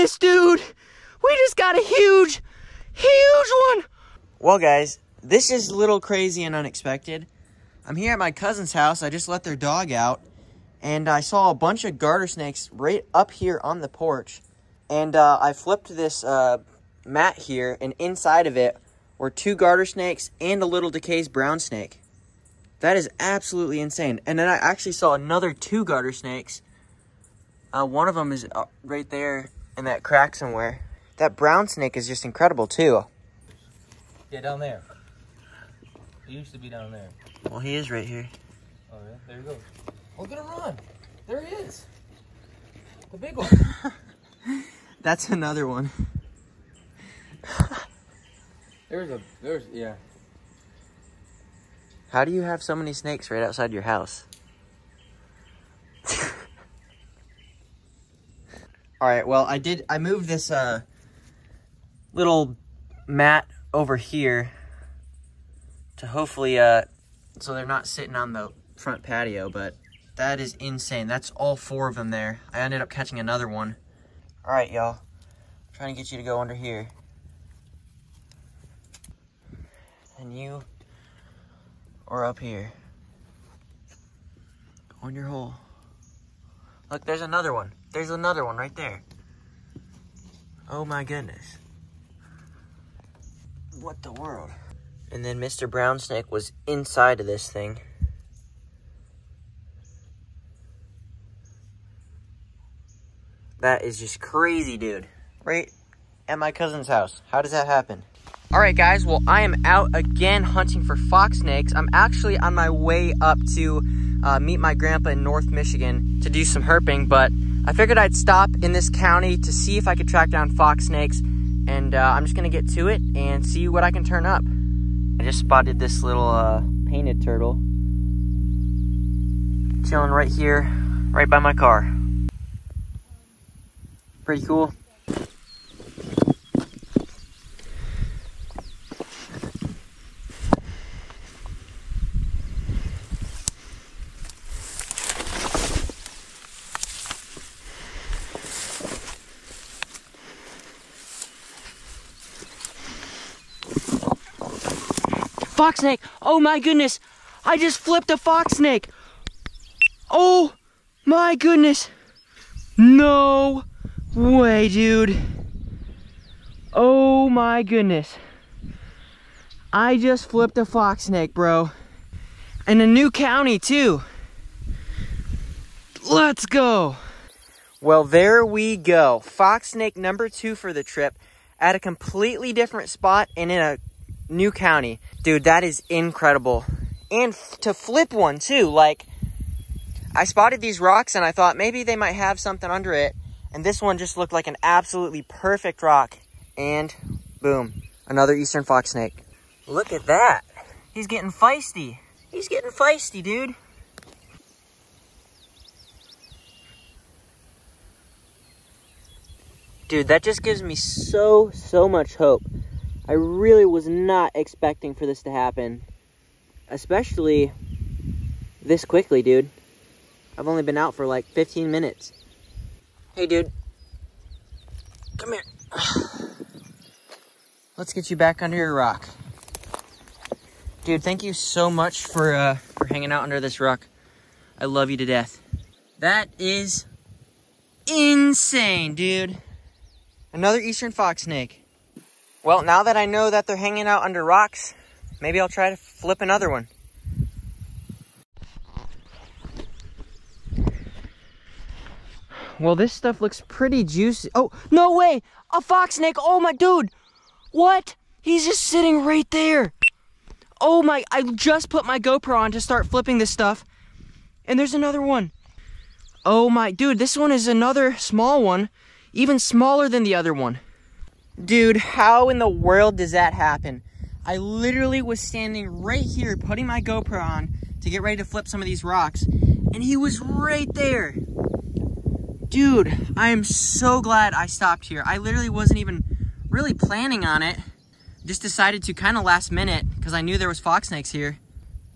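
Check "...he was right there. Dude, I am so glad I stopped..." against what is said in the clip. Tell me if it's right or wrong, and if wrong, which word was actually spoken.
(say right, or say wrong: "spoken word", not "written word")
right.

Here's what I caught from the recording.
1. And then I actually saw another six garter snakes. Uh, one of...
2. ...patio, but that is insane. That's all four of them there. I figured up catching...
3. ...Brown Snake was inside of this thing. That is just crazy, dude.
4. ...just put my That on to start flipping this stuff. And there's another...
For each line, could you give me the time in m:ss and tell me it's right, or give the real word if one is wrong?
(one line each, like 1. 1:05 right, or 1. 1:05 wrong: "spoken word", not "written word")
1. 0:24 wrong: "two", not "six"
2. 1:09 wrong: "ended", not "figured"
3. 1:35 right
4. 4:21 wrong: "GoPro", not "That".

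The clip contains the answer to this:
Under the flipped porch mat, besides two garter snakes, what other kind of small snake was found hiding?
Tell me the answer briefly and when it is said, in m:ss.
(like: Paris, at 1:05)
DeKay's brown snake, at 0:20.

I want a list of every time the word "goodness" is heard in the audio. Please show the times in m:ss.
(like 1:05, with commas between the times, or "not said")
1:31, 2:36, 2:41, 2:47.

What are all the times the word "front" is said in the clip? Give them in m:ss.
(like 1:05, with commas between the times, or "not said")
1:08.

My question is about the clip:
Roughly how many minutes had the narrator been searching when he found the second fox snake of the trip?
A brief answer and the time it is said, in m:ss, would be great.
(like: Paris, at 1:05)
15, at 3:41.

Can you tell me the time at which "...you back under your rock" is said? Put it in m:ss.
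3:48.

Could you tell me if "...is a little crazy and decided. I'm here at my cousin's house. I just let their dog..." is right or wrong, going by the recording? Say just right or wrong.
wrong.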